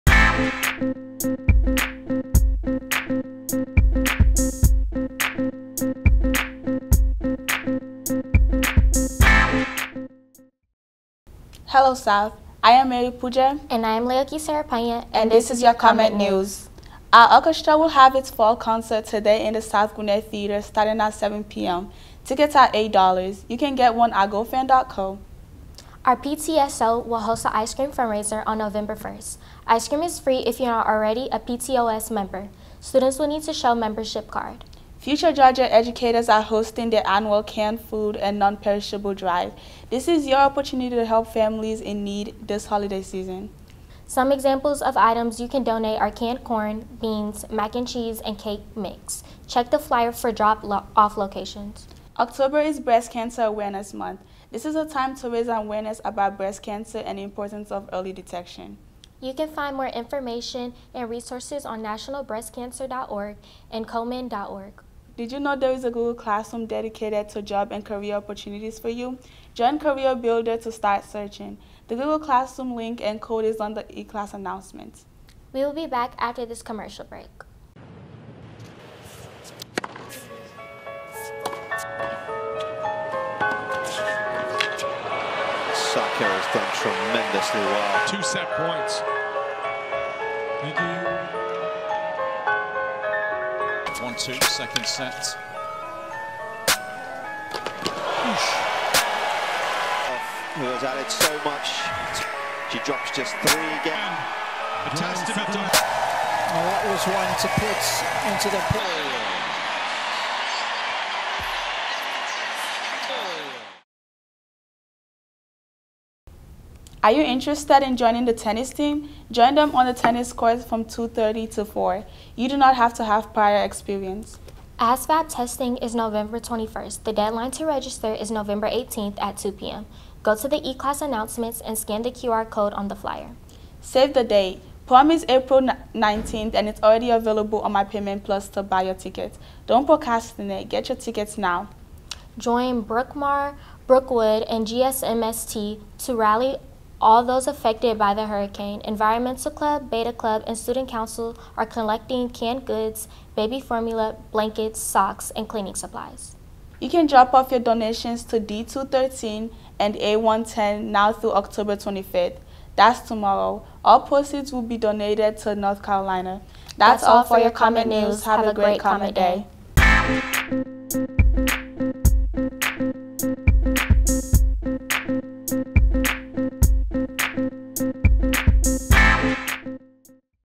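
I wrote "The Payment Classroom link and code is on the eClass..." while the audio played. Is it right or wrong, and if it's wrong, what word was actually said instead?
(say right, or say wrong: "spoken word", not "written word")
wrong: "Google", not "Payment".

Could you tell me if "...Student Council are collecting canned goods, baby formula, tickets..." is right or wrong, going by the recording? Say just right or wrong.
wrong.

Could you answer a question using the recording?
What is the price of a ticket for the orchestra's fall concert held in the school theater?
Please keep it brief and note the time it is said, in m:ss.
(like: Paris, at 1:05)
$8, at 0:22.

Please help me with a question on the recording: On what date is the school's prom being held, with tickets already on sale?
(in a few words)
April 19th.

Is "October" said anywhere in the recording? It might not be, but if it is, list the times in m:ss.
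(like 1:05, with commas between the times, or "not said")
0:52, 2:41.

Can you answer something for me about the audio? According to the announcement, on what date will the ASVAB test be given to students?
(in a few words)
November 21st.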